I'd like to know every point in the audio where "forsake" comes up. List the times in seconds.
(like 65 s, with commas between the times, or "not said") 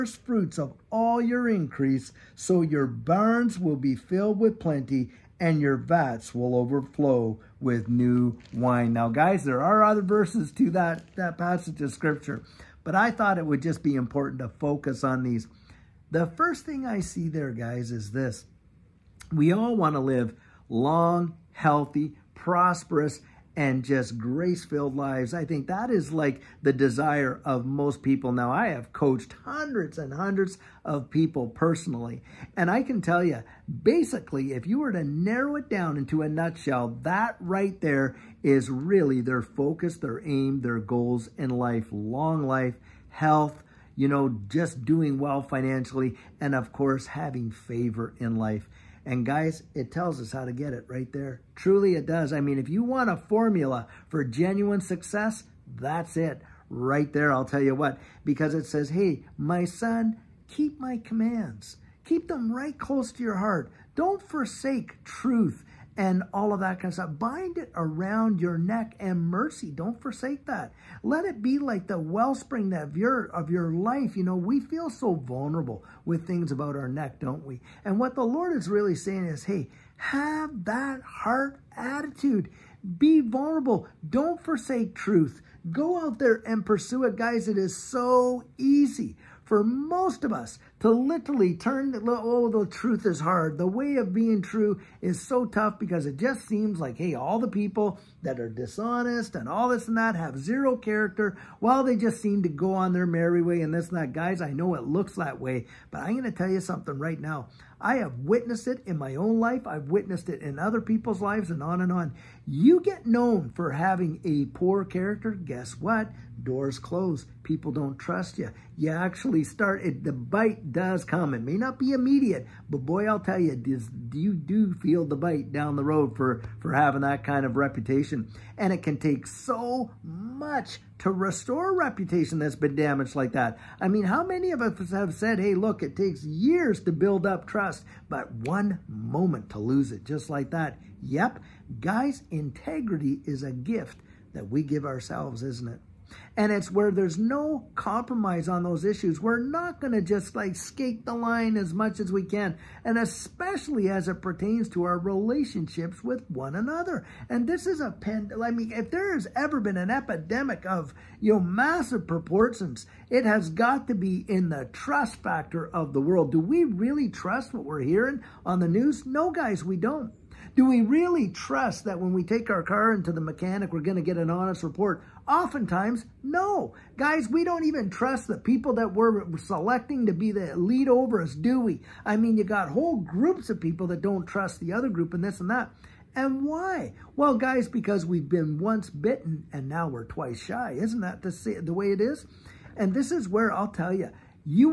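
64 s, 70 s, 84 s.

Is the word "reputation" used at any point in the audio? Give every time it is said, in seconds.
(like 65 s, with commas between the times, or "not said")
127 s, 131 s.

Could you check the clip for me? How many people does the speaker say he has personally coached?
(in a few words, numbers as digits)
Hundreds and hundreds.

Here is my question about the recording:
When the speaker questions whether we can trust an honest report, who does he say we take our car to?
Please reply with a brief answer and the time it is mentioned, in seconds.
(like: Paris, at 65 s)
The mechanic, at 173 s.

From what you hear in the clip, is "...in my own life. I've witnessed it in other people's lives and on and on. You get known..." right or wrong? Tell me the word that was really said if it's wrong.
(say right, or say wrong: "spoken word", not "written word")
right.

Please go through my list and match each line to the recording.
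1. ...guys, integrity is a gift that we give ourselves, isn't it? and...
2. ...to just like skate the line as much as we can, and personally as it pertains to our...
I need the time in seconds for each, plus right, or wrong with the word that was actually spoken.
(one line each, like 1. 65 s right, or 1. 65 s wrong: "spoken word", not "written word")
1. 141 s right
2. 149 s wrong: "especially", not "personally".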